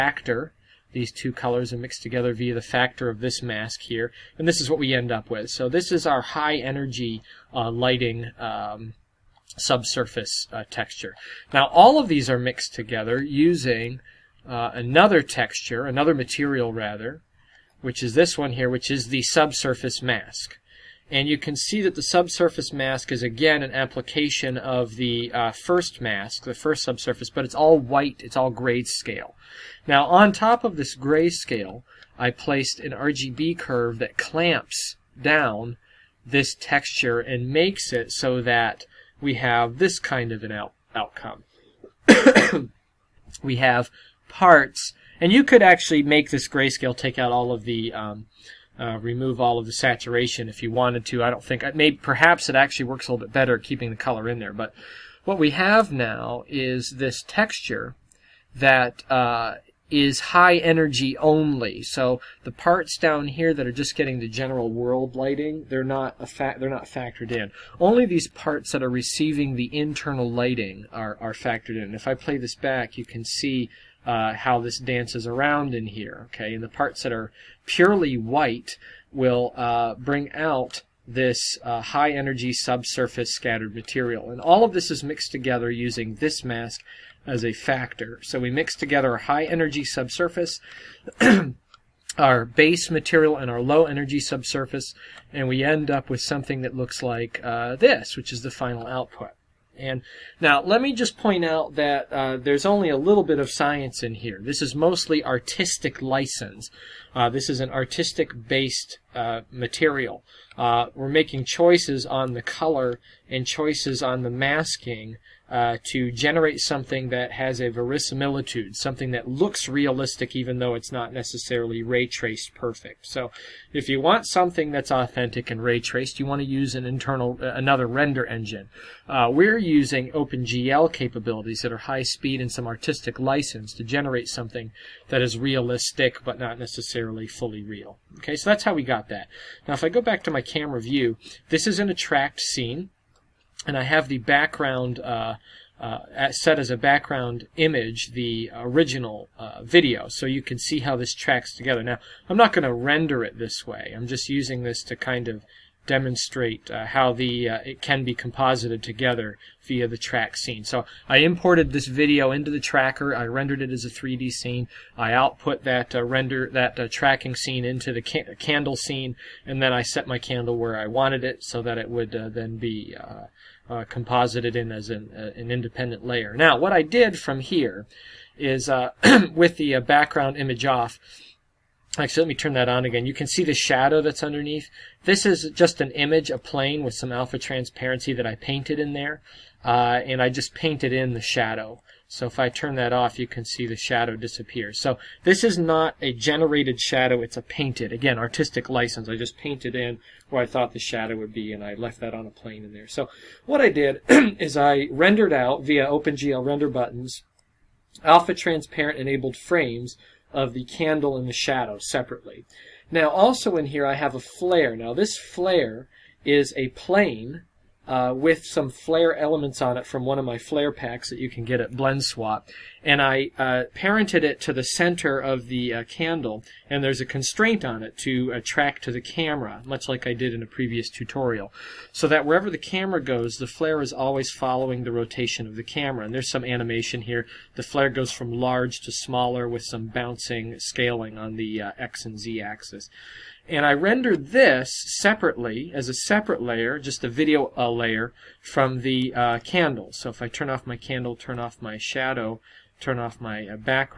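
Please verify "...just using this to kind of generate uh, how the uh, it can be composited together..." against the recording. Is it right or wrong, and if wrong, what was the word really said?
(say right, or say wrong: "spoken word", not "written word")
wrong: "demonstrate", not "generate".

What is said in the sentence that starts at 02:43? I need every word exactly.
I rendered it as a 3D scene.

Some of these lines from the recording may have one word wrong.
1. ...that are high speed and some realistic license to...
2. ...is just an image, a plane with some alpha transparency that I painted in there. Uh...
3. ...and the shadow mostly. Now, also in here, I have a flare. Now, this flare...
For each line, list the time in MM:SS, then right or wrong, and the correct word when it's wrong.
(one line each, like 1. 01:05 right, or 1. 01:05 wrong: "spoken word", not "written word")
1. 02:11 wrong: "artistic", not "realistic"
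2. 03:05 right
3. 03:31 wrong: "separately", not "mostly".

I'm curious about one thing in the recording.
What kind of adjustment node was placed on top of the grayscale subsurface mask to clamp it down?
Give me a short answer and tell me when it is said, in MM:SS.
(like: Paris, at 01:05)
RGB curve, at 00:32.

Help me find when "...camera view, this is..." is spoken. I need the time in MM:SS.
02:20.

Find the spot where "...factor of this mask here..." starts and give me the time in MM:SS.
00:02.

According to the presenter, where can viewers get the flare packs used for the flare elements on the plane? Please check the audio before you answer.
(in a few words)
Blend Swap.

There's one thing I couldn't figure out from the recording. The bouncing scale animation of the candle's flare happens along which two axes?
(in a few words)
X and Z.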